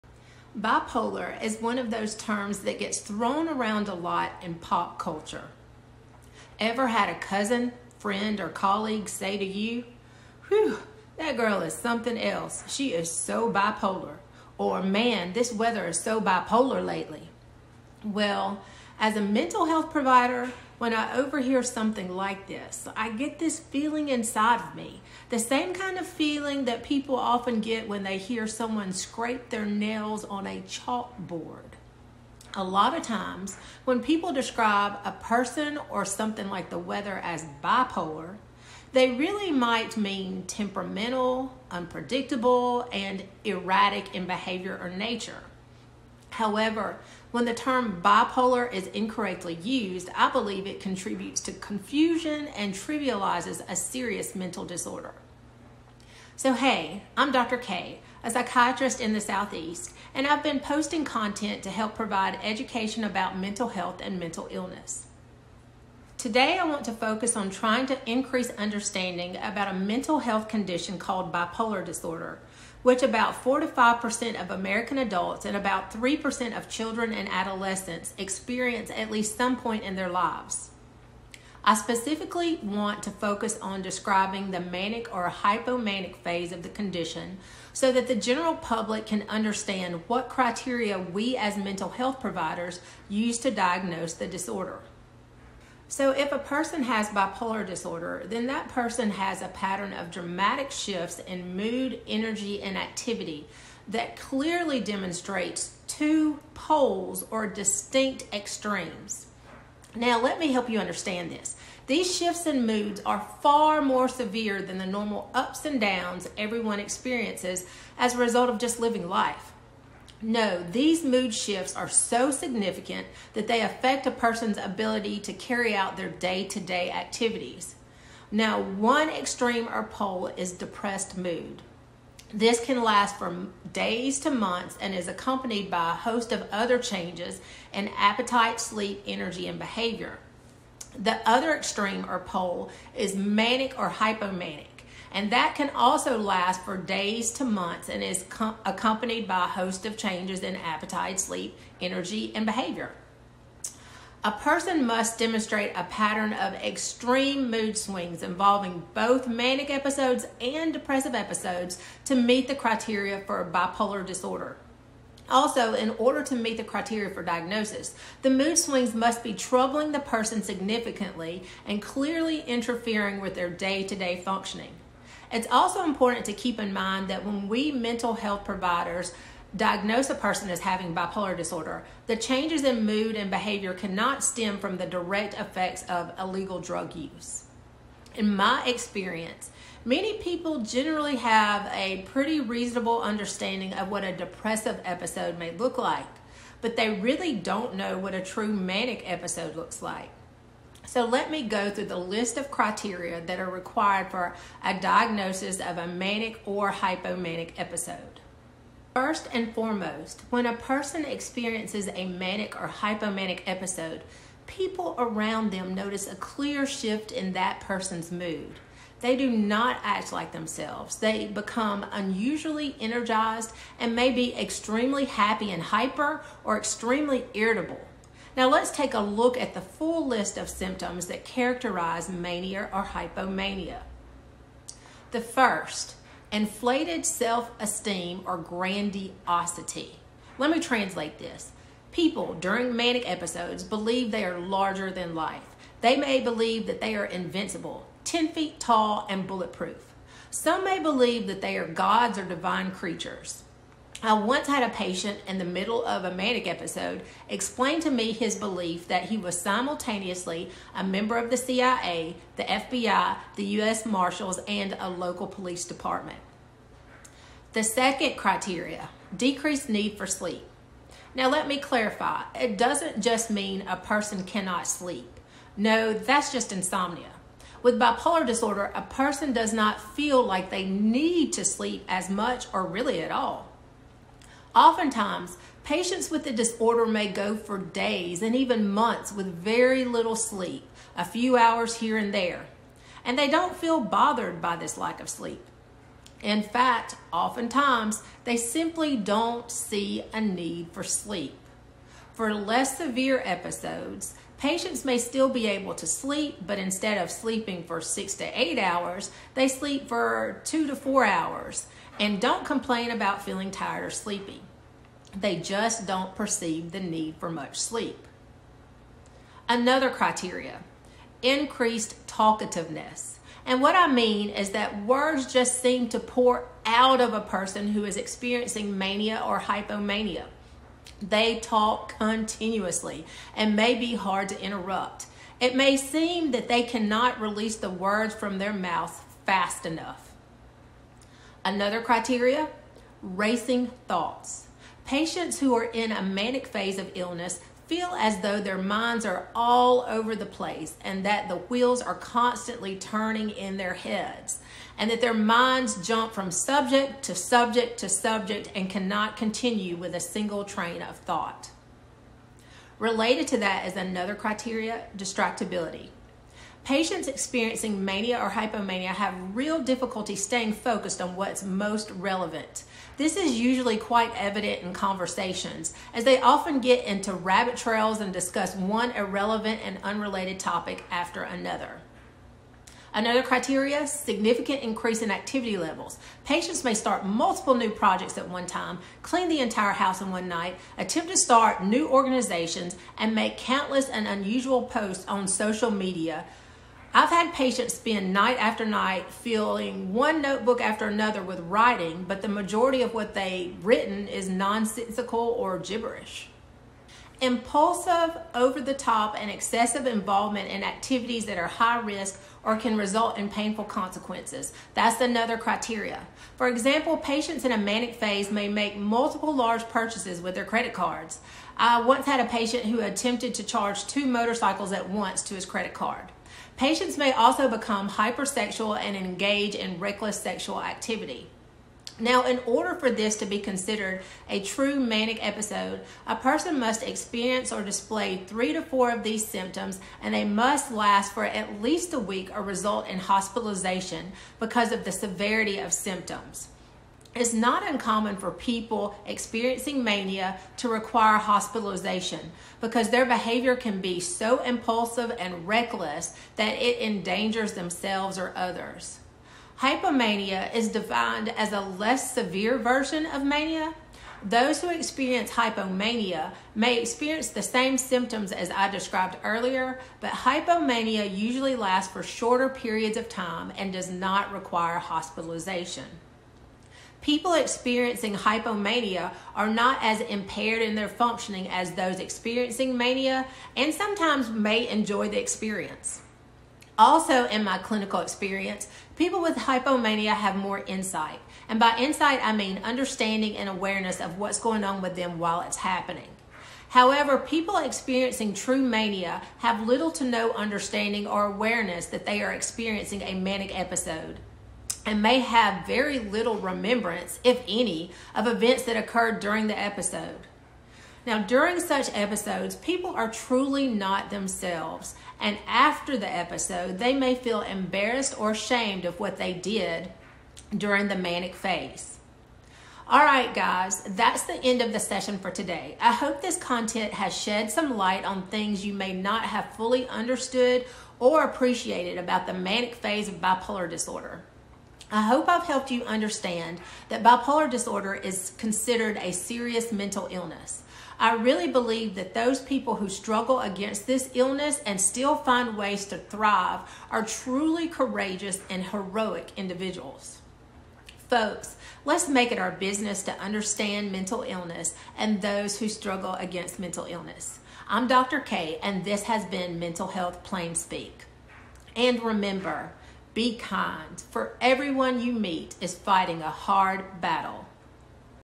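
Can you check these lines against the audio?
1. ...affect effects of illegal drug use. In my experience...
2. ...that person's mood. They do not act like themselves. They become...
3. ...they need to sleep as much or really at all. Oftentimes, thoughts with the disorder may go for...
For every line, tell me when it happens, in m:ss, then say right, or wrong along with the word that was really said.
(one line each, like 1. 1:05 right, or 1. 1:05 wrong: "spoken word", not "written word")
1. 3:04 wrong: "direct", not "affect"
2. 3:37 right
3. 4:40 wrong: "patients", not "thoughts".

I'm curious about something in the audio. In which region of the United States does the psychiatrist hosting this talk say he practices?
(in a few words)
the Southeast.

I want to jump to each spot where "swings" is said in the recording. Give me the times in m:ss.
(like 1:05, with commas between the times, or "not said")
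2:37, 2:48.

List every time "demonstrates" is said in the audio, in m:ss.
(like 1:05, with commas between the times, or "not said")
1:44, 2:35.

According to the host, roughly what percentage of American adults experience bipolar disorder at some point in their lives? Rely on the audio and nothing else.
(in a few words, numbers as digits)
4 to 5%.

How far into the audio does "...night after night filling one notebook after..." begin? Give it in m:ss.
6:38.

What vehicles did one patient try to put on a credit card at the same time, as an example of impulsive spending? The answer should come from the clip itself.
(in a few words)
two motorcycles.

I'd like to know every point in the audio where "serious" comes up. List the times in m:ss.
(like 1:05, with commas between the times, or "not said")
0:53, 8:59.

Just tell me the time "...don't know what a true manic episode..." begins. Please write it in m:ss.
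3:17.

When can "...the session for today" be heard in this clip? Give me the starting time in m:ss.
8:44.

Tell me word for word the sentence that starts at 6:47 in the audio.
Impulsive, over the top, and excessive involvement in activities that are high risk or can result in painful consequences.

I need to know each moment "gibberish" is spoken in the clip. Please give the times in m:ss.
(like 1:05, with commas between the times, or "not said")
6:45.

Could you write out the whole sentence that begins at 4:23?
Marshals, and a local police department.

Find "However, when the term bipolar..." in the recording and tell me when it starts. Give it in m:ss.
0:46.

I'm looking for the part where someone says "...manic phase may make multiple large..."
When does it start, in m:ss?
6:57.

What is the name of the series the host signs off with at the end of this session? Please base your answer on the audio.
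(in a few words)
Mental Health Plain Speak.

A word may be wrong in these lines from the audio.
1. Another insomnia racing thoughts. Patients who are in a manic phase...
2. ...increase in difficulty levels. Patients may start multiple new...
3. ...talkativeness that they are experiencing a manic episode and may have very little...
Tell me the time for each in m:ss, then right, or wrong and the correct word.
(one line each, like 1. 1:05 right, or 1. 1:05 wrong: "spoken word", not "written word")
1. 5:41 wrong: "criteria", not "insomnia"
2. 6:24 wrong: "activity", not "difficulty"
3. 8:21 wrong: "awareness", not "talkativeness".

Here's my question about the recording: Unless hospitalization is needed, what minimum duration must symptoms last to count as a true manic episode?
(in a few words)
at least a week.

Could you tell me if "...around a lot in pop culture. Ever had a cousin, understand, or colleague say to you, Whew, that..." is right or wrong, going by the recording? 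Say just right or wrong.
wrong.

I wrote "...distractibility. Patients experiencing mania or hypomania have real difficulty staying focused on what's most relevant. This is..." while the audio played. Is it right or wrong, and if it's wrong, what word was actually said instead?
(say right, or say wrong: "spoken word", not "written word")
right.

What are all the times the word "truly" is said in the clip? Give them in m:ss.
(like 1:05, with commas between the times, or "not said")
8:33, 9:07.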